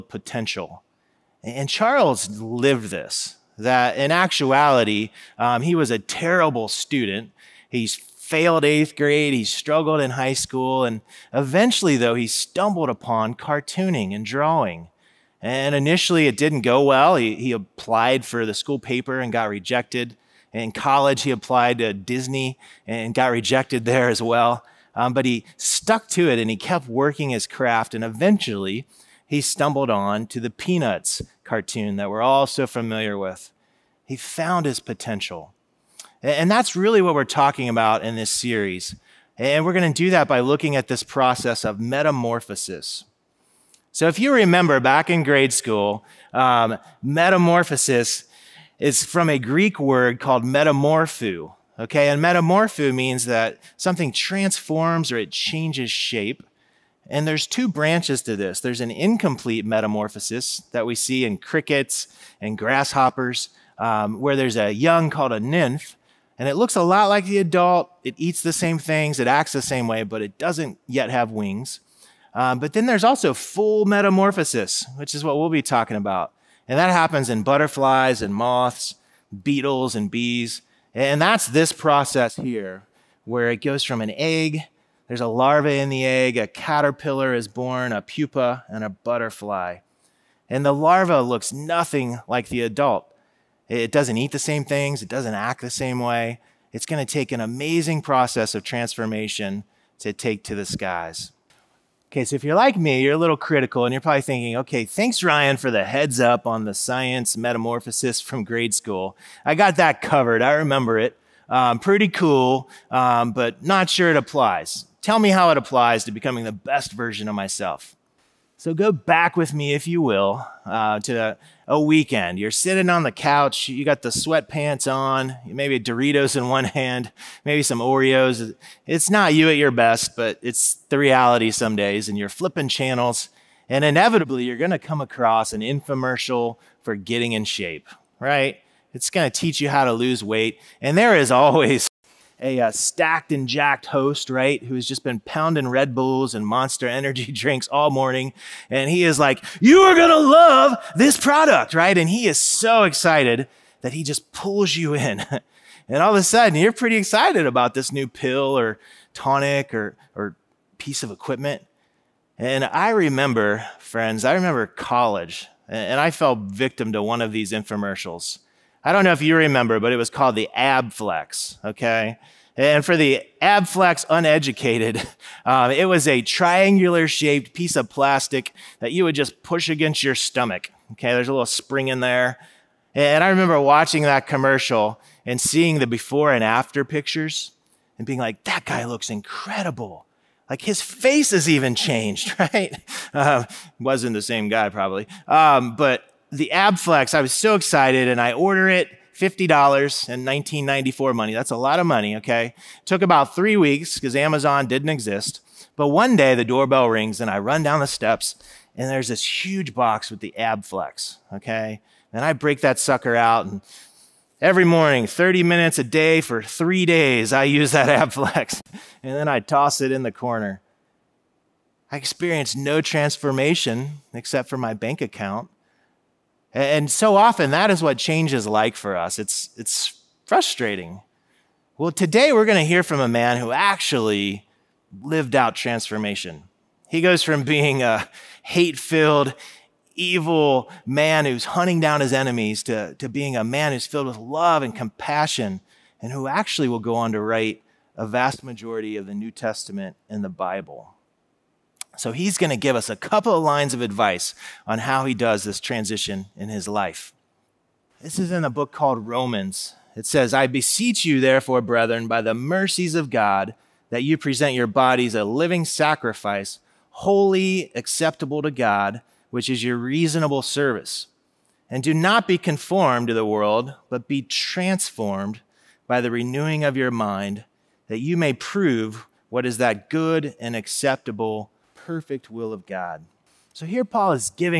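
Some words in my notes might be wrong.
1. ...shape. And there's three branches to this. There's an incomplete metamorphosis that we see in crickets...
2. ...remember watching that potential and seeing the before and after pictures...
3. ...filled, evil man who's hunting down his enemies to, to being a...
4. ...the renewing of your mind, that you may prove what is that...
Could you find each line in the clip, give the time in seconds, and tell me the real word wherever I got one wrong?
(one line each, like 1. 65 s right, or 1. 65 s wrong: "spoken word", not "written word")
1. 55 s wrong: "two", not "three"
2. 183 s wrong: "commercial", not "potential"
3. 238 s right
4. 276 s right.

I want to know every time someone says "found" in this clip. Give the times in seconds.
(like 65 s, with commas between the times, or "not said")
34 s.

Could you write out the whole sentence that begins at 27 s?
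And eventually, he stumbled on to the Peanuts cartoon that we're all so familiar with.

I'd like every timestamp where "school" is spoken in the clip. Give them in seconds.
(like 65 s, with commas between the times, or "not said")
10 s, 18 s, 45 s, 108 s.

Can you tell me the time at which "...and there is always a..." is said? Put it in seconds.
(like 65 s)
140 s.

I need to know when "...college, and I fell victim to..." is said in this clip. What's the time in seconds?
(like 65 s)
164 s.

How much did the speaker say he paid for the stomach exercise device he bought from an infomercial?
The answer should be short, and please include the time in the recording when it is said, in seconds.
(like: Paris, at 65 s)
$50, at 199 s.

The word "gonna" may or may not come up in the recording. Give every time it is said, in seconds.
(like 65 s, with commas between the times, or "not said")
134 s, 139 s.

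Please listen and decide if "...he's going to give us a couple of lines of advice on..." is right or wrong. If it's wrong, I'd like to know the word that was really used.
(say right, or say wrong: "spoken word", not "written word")
right.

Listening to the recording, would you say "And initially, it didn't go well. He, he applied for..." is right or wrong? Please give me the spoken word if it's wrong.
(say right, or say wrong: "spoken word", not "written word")
right.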